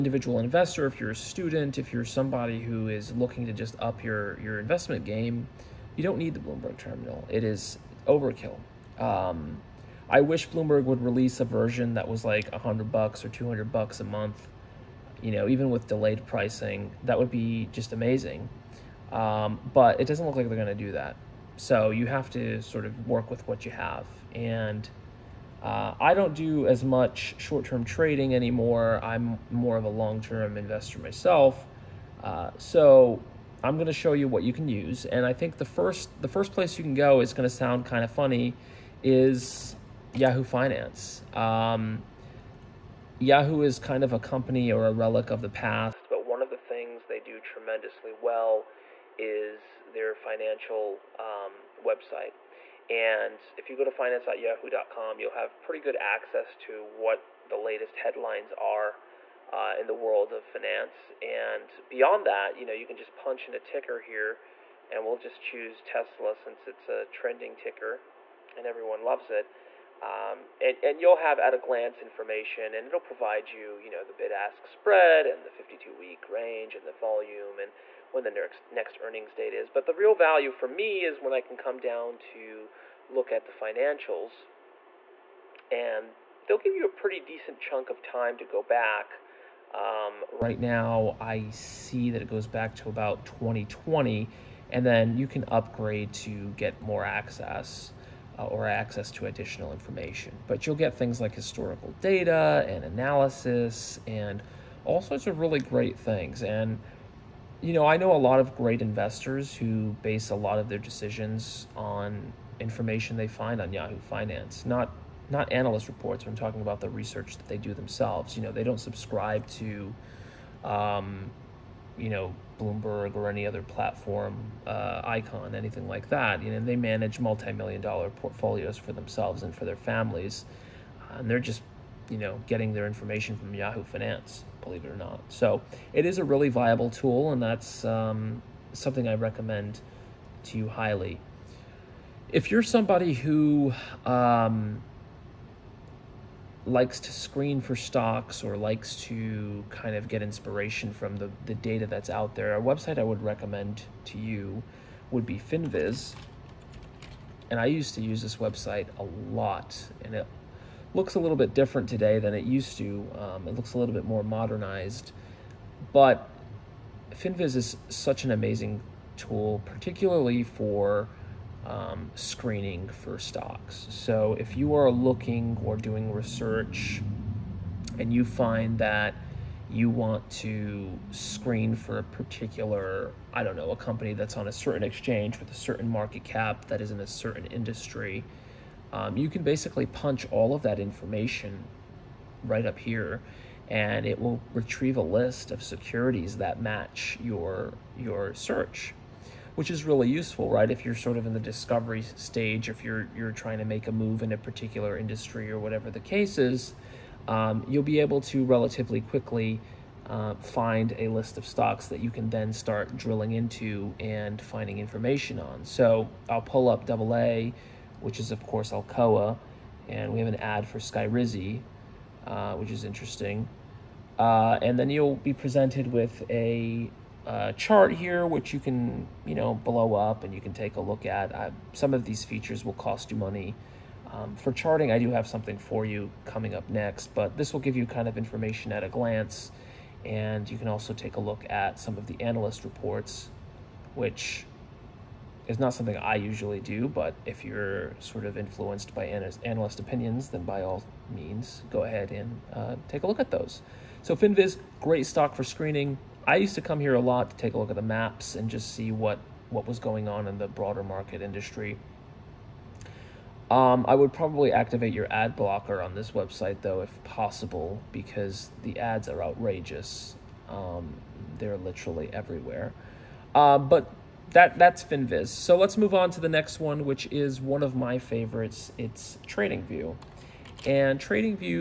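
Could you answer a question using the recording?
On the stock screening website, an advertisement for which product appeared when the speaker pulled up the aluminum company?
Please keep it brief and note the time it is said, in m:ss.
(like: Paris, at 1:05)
Skyrizi, at 3:40.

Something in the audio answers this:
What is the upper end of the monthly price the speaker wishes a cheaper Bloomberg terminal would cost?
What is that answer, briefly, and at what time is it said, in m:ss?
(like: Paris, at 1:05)
200 bucks, at 0:13.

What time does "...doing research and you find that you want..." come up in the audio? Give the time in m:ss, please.
2:55.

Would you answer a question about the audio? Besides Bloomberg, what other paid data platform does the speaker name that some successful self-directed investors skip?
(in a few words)
Eikon.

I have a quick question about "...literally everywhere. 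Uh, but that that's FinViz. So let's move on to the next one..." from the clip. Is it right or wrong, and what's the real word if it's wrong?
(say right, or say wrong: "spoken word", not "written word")
right.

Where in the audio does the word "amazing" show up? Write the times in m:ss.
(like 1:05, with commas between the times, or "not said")
0:17, 2:48.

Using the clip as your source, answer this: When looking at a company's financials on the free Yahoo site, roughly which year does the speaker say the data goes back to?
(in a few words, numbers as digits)
2020.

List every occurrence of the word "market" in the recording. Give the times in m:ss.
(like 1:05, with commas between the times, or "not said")
3:05, 4:20.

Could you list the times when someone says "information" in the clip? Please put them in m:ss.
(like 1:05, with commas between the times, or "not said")
1:12, 1:39, 1:52, 2:12, 3:10, 3:34, 3:58.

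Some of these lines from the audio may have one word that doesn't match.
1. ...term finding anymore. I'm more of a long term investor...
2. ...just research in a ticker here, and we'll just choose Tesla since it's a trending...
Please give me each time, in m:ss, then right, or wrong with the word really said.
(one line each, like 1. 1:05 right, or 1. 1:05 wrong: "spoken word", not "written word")
1. 0:27 wrong: "trading", not "finding"
2. 1:02 wrong: "punch", not "research".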